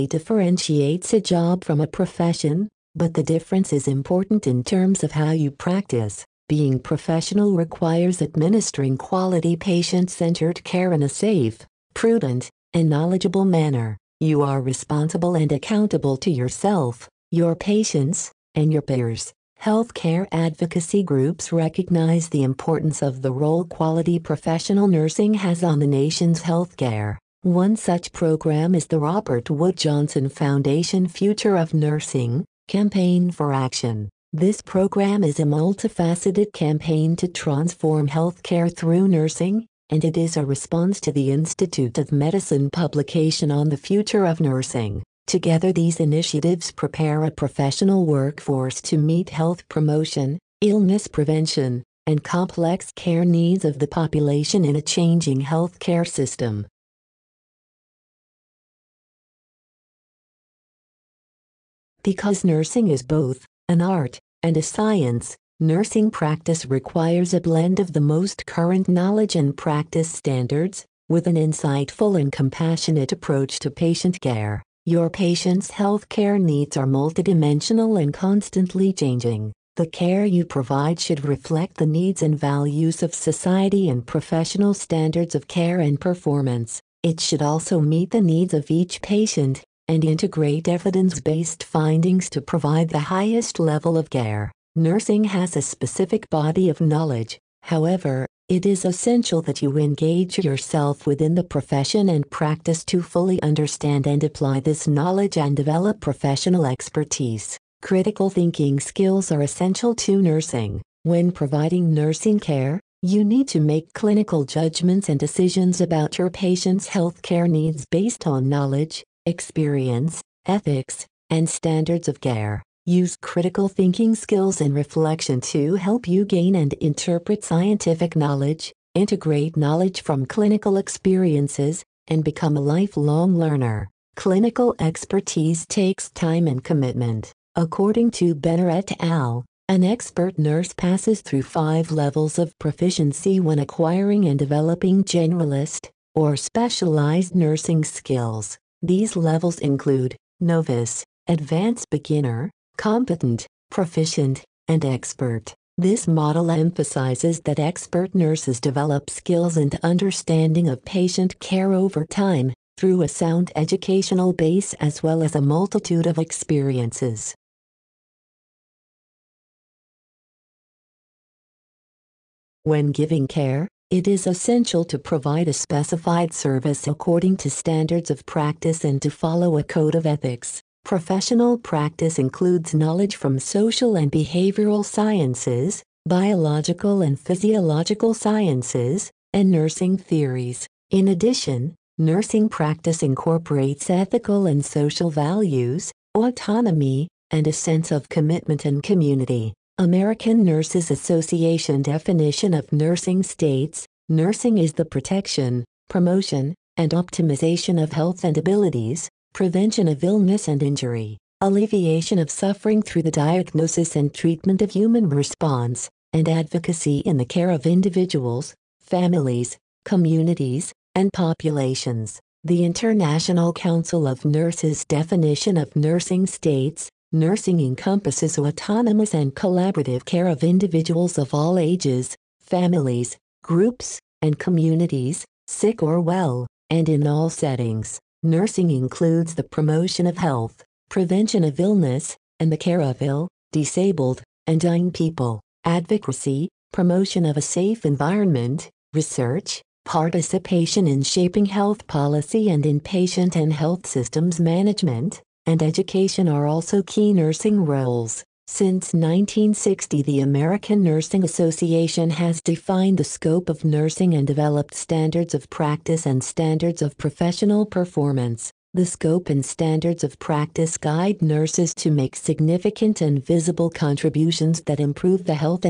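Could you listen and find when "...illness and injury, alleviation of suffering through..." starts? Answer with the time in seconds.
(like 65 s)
210 s.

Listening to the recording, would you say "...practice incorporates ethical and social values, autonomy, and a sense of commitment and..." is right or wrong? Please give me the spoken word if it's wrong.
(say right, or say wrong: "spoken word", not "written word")
right.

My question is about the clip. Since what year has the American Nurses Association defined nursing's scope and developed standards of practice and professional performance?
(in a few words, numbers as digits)
1960.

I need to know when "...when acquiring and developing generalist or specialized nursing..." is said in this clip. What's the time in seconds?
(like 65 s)
143 s.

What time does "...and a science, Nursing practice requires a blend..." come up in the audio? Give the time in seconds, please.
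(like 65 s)
64 s.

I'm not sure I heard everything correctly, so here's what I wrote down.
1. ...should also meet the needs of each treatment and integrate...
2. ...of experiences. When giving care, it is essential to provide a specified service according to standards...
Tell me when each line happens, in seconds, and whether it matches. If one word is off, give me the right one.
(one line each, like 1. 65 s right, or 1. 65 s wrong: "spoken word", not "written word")
1. 87 s wrong: "patient", not "treatment"
2. 166 s right.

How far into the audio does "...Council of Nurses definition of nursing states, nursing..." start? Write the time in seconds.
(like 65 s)
223 s.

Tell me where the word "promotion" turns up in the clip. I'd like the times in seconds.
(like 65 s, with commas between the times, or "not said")
49 s, 205 s, 239 s, 246 s.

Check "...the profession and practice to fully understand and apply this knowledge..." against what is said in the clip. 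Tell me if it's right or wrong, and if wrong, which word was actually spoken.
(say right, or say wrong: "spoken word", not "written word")
right.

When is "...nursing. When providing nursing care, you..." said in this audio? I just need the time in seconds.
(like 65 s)
110 s.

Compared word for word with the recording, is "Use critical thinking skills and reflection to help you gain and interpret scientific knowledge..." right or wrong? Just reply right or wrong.
right.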